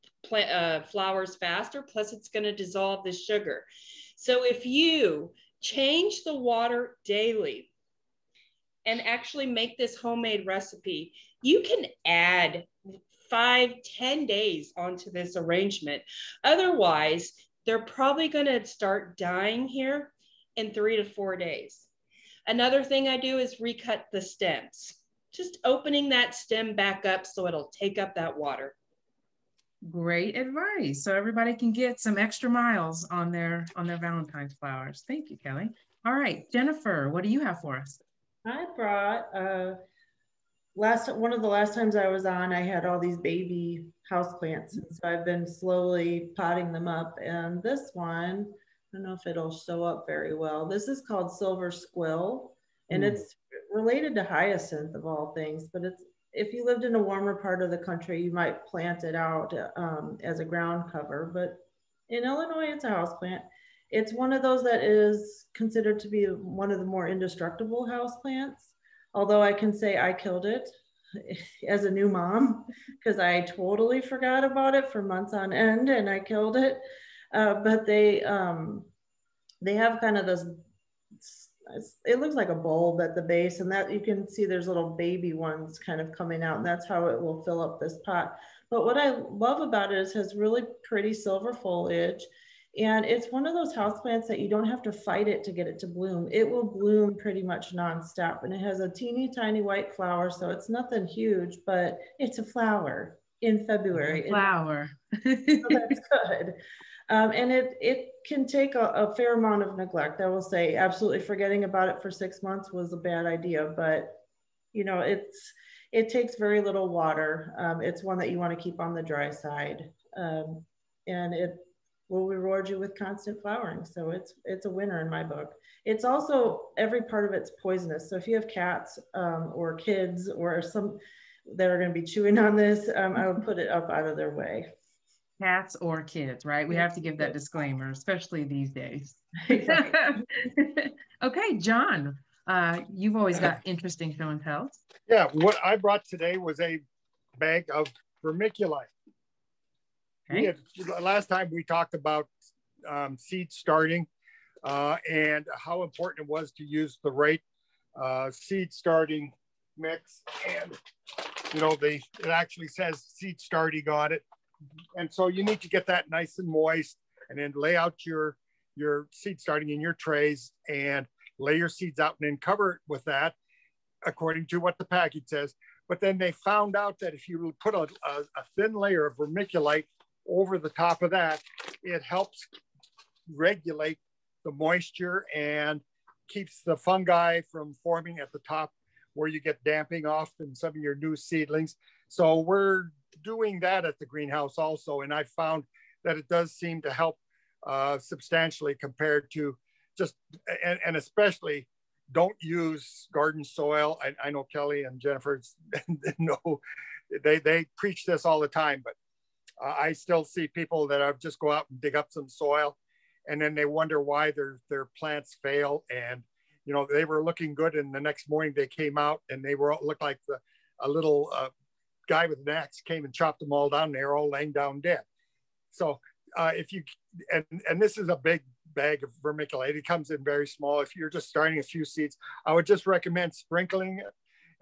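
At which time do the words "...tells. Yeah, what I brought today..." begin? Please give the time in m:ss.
2:24.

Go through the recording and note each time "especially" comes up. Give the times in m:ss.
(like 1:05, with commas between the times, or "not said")
2:17, 3:20.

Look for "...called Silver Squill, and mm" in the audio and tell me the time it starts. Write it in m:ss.
0:51.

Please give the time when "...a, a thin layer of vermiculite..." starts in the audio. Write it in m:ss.
2:57.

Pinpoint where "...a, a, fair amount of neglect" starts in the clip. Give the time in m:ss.
1:48.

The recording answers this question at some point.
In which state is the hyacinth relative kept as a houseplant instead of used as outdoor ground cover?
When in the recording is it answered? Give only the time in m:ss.
1:02.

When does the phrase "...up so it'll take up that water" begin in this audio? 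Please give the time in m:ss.
0:27.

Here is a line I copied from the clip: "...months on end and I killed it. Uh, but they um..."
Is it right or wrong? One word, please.
right.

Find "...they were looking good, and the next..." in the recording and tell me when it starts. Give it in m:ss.
3:36.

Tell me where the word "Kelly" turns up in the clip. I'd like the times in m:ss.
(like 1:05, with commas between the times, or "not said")
0:35, 3:24.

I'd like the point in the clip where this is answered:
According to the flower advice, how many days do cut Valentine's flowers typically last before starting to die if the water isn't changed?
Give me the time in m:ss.
0:20.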